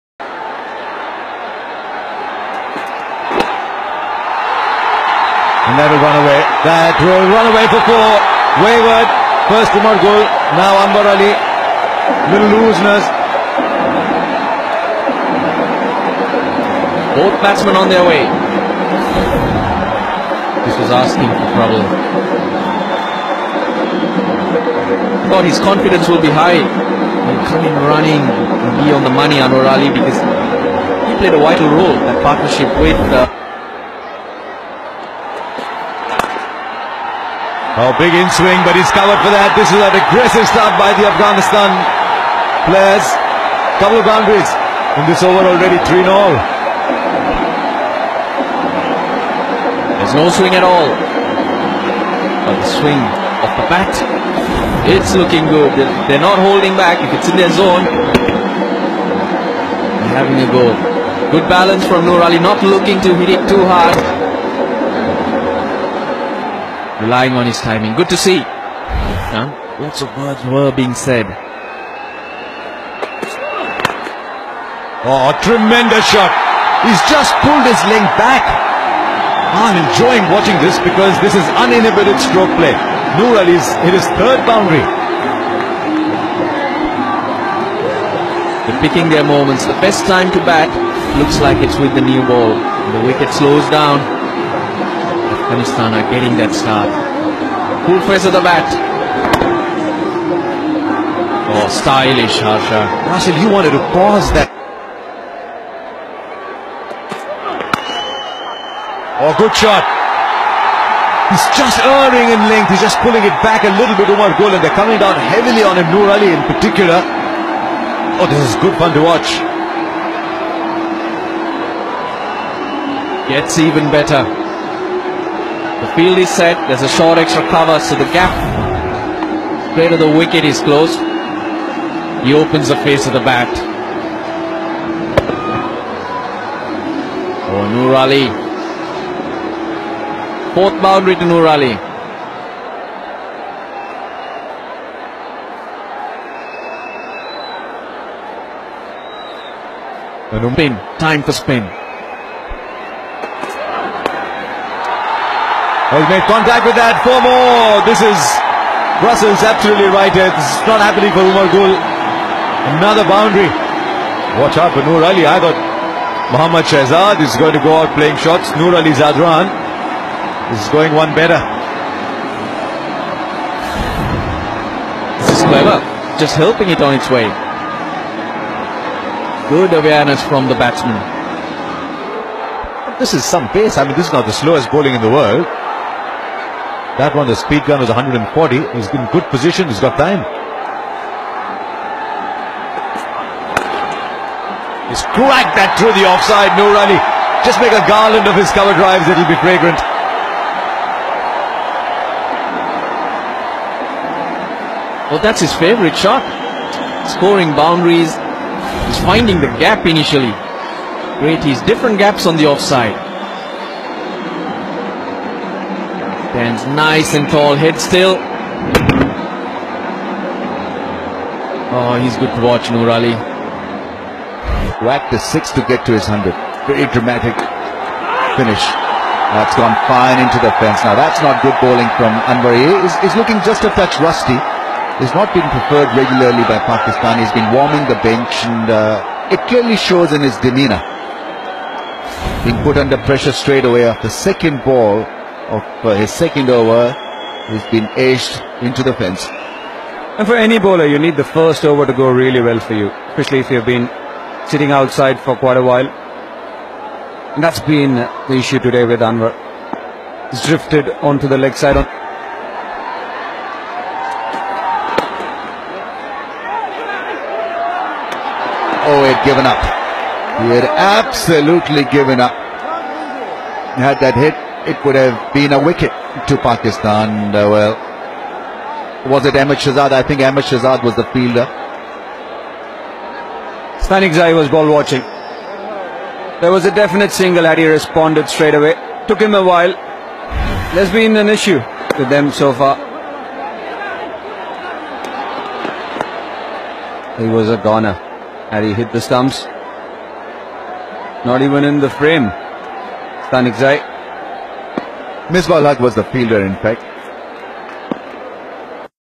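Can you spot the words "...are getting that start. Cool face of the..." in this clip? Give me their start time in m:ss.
1:35.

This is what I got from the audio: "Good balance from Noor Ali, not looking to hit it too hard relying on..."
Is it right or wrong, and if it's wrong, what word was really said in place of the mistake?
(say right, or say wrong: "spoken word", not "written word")
right.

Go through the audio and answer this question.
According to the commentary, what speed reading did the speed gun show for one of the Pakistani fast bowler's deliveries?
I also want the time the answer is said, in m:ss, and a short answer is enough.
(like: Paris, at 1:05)
140, at 3:07.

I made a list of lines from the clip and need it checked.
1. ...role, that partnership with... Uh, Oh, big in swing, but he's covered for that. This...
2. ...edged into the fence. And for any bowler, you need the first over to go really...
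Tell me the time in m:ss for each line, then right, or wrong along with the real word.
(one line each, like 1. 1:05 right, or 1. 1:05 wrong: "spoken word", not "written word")
1. 0:31 right
2. 4:08 right.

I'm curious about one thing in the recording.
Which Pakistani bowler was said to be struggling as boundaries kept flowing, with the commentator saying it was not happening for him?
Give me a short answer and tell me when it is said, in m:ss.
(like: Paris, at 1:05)
Umar Gul, at 2:41.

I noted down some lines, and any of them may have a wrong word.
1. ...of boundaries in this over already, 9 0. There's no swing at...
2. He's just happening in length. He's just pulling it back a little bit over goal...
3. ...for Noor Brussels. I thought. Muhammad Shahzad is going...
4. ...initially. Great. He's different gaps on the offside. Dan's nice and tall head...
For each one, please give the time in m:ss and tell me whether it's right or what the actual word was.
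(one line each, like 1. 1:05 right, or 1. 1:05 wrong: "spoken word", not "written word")
1. 0:43 wrong: "3", not "9"
2. 1:51 wrong: "erring", not "happening"
3. 2:44 wrong: "Ali", not "Brussels"
4. 3:29 right.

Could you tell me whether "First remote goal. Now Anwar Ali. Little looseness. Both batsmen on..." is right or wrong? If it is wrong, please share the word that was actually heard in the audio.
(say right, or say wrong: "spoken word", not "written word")
right.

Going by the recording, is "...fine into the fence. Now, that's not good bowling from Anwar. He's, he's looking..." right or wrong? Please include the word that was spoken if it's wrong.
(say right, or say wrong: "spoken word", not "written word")
right.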